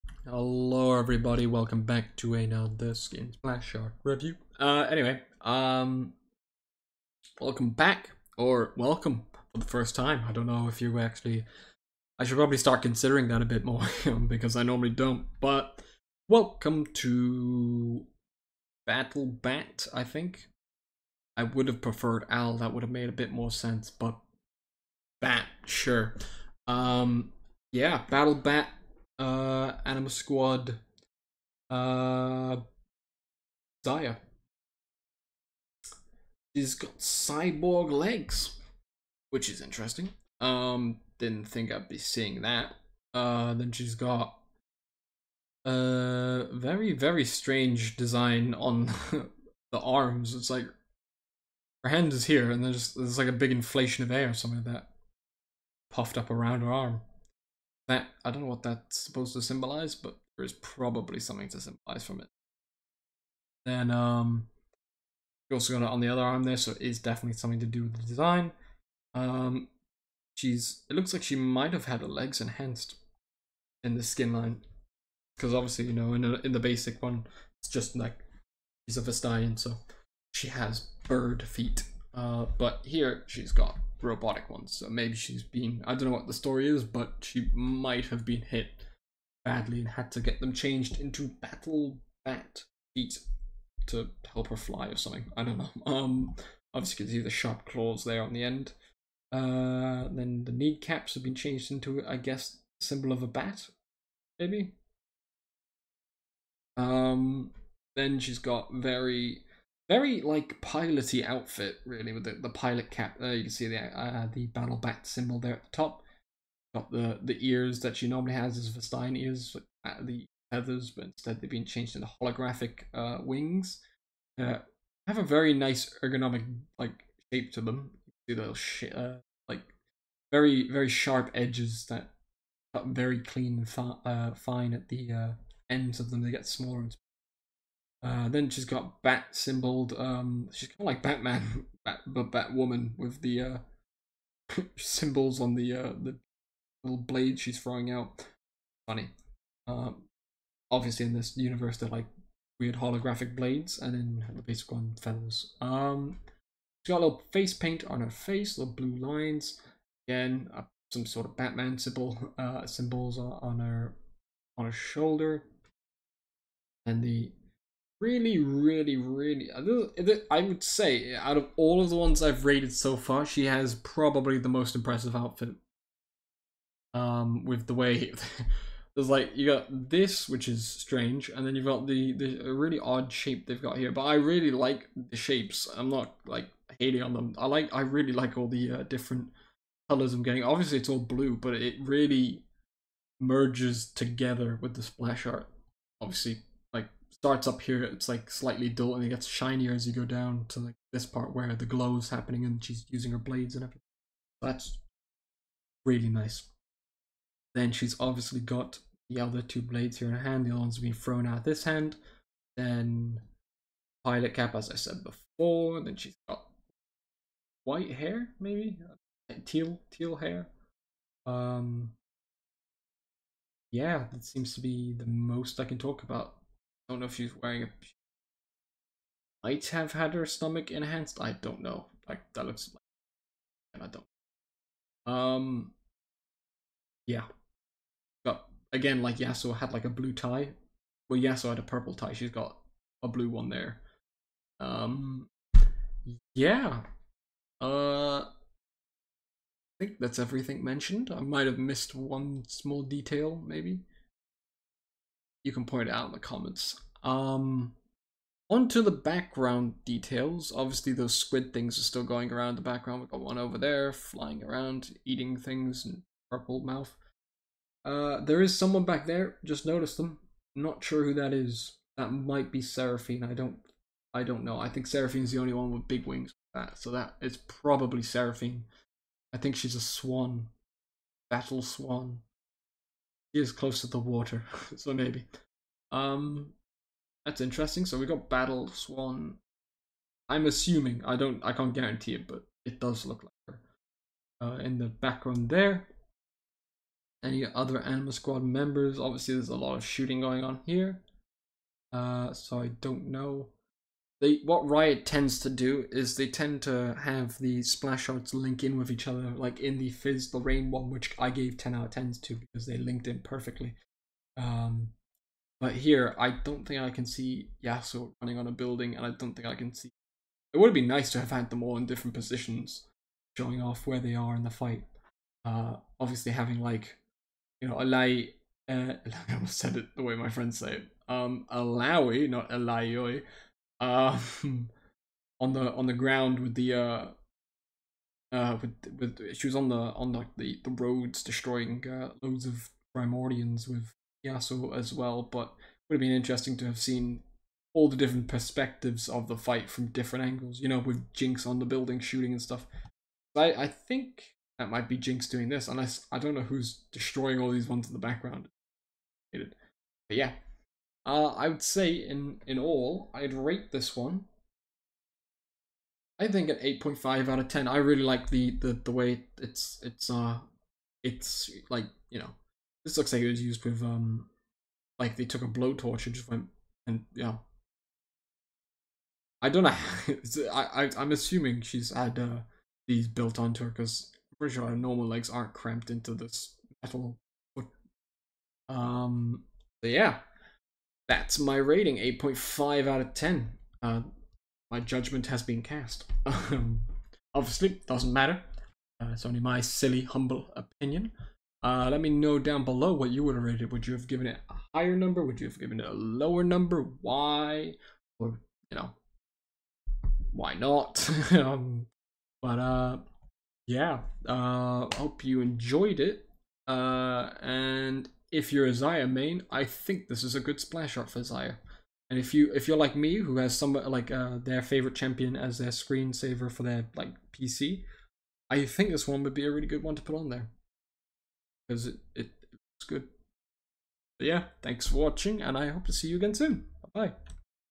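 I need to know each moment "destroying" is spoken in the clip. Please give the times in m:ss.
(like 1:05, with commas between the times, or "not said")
5:41, 5:56.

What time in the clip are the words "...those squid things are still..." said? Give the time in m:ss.
4:20.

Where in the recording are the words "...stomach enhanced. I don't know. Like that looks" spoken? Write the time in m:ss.
3:50.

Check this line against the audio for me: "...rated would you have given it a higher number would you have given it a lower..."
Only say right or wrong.
right.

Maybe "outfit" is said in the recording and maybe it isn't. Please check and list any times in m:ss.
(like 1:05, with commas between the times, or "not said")
1:51, 2:55.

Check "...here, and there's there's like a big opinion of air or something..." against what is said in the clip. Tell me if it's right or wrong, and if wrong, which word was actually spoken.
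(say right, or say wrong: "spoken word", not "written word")
wrong: "inflation", not "opinion".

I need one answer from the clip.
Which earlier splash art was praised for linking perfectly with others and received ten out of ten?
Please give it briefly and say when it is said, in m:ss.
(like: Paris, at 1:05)
Fizz the Rain, at 5:09.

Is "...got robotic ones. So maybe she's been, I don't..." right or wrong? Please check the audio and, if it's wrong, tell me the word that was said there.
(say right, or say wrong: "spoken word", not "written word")
right.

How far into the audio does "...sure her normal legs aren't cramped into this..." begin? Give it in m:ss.
6:24.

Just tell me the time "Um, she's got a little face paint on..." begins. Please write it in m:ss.
2:35.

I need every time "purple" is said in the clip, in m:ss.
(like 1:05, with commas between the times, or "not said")
4:01, 4:26.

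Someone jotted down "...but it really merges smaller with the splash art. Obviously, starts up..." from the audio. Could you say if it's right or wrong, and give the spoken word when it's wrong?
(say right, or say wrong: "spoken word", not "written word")
wrong: "together", not "smaller".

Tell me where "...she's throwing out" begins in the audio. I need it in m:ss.
2:27.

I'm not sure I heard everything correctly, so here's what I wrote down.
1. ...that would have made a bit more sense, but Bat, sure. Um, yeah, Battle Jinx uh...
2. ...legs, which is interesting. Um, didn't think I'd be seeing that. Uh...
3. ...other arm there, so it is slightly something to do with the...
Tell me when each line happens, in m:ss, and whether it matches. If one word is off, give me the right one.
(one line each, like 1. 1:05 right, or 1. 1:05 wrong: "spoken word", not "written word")
1. 0:22 wrong: "Bat", not "Jinx"
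2. 0:37 right
3. 1:06 wrong: "definitely", not "slightly".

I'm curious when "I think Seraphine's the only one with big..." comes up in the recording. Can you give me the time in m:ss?
4:34.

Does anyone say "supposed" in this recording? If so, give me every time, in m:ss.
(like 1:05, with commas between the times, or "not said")
0:58.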